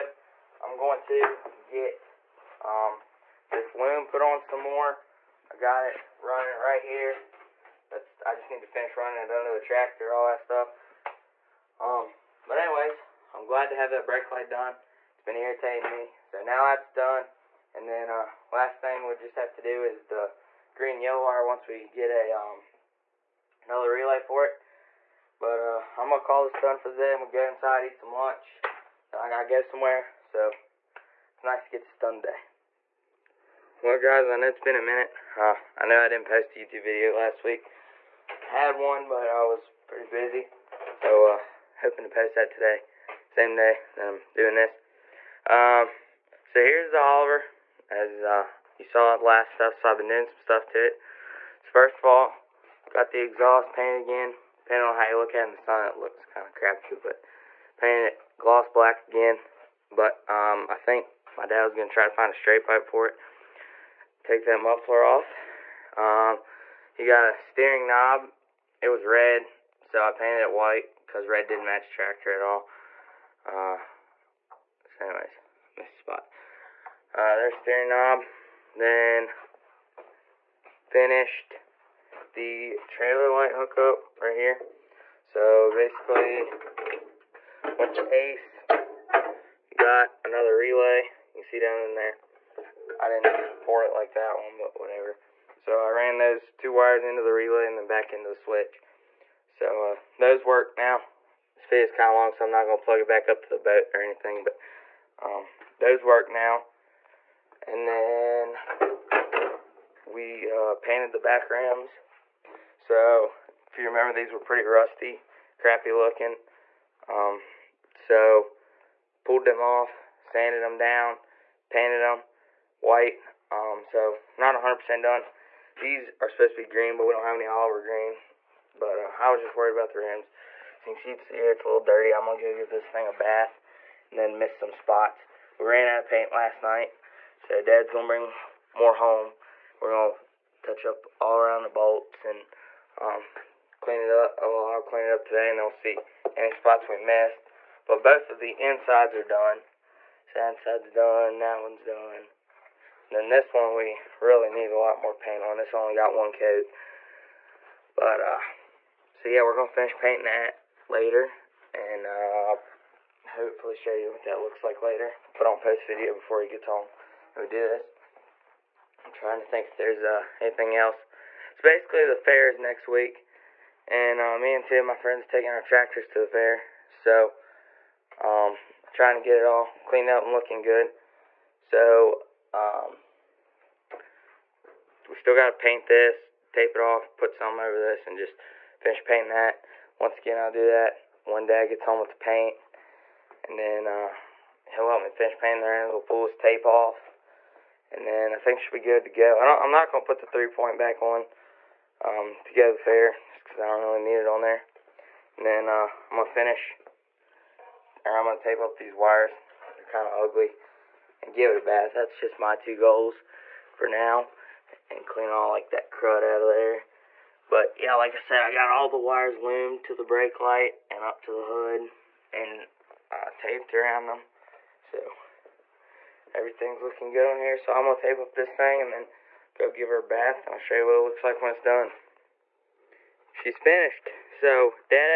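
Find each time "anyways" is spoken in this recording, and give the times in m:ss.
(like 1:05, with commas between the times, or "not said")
0:12, 1:15.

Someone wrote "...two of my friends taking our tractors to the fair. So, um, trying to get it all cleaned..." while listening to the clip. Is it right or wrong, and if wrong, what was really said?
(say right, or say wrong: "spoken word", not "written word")
right.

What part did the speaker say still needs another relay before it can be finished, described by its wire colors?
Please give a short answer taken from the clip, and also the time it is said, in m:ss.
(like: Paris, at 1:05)
green yellow wire, at 0:20.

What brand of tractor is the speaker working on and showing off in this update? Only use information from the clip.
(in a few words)
Oliver.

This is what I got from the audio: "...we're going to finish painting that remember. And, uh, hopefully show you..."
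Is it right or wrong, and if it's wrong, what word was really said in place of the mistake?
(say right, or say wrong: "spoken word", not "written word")
wrong: "later", not "remember".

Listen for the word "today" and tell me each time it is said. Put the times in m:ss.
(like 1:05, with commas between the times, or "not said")
0:32, 0:42, 2:25.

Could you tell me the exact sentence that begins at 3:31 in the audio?
That's just my two goals for now and clean all like that crud out of there.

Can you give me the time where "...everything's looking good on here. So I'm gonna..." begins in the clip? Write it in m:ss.
3:46.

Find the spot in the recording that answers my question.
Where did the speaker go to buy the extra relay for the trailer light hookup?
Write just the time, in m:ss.
1:28.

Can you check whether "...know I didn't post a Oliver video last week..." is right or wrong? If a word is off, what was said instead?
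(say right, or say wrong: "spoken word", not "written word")
wrong: "YouTube", not "Oliver".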